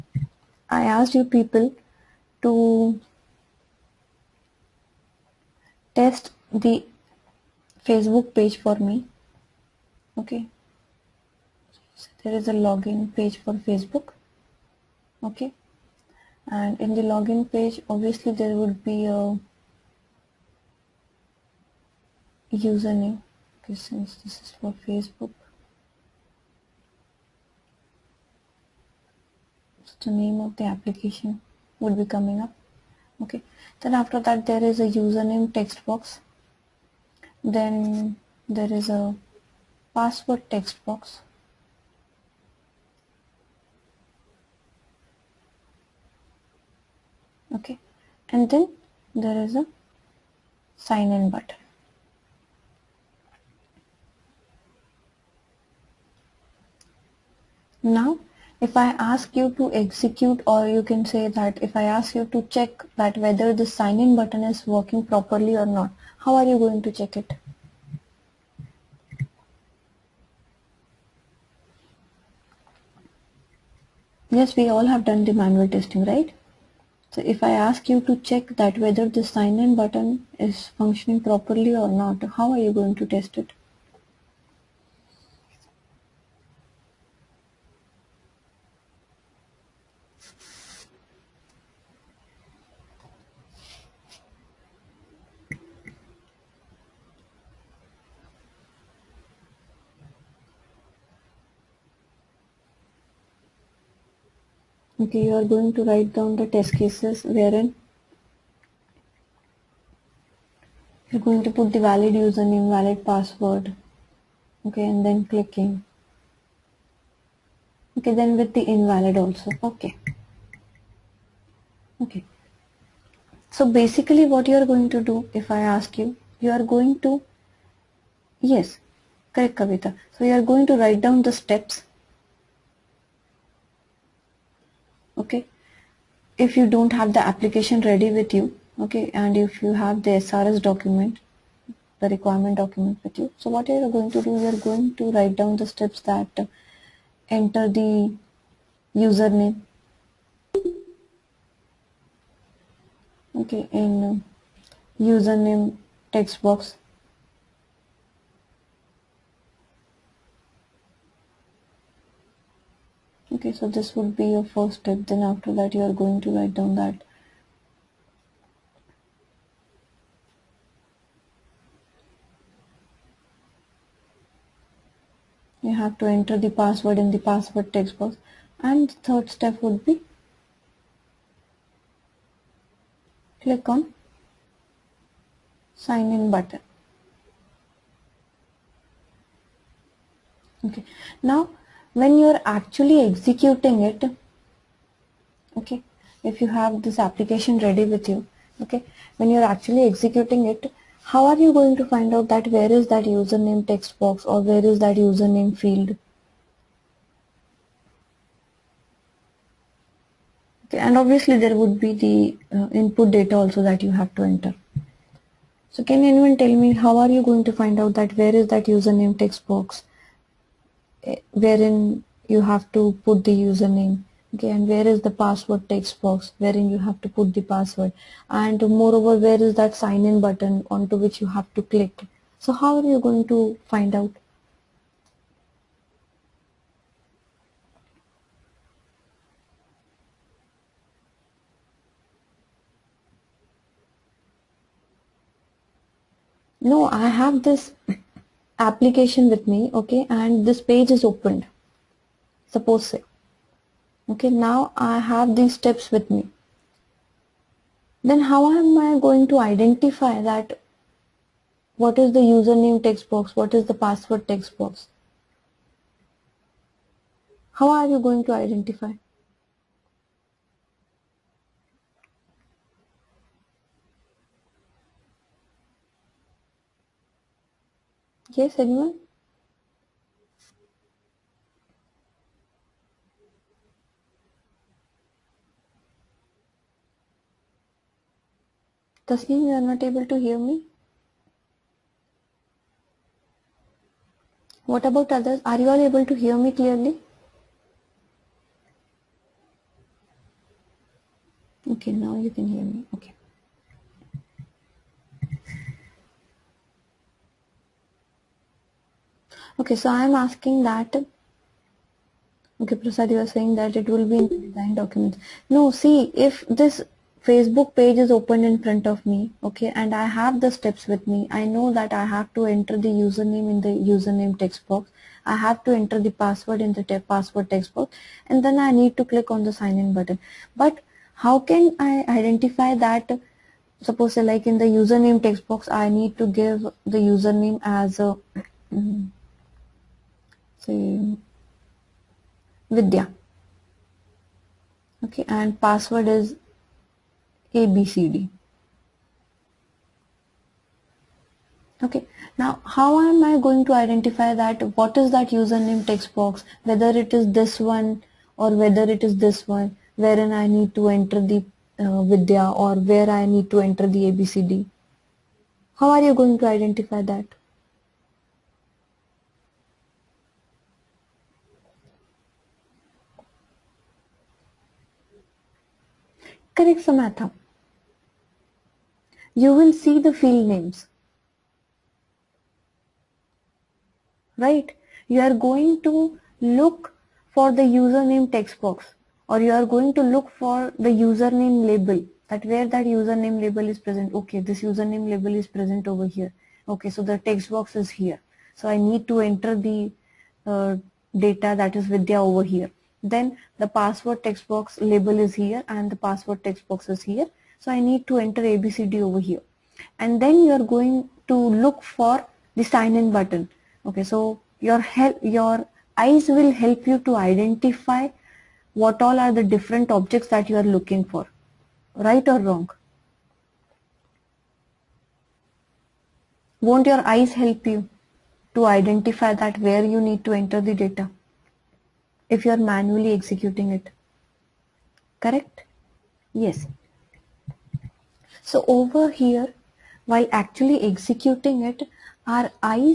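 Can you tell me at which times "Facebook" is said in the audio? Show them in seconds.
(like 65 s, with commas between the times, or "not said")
7 s, 13 s, 24 s, 317 s.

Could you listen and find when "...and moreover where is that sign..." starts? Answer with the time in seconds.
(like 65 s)
228 s.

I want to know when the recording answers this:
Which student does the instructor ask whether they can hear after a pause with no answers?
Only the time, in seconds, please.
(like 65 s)
289 s.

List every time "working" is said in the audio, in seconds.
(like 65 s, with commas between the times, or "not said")
64 s.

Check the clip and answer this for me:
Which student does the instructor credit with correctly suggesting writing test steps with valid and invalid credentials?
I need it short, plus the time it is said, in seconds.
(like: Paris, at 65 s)
Kavita, at 129 s.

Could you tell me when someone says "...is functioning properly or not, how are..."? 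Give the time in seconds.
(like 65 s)
80 s.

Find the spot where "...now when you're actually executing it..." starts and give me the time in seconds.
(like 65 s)
191 s.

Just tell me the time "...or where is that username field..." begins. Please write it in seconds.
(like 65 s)
204 s.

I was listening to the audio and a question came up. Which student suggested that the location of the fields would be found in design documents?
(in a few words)
Prasad.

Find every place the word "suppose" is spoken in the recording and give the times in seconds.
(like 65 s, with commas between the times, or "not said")
252 s, 333 s.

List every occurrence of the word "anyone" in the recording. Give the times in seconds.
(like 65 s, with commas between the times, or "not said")
216 s, 278 s.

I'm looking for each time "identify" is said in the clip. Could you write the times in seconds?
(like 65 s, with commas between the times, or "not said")
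259 s, 268 s, 332 s, 353 s, 366 s, 417 s, 428 s.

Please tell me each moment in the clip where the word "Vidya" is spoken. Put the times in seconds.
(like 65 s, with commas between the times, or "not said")
342 s, 362 s, 401 s.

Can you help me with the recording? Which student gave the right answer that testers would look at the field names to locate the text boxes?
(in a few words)
Samatha.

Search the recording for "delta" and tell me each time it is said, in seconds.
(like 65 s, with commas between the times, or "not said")
not said.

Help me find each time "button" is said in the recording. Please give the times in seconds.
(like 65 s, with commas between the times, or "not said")
51 s, 64 s, 79 s, 186 s, 230 s, 329 s, 413 s.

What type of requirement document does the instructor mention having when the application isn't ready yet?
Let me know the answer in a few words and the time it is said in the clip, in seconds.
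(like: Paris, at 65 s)
SRS document, at 140 s.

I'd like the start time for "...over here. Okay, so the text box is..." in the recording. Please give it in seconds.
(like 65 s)
395 s.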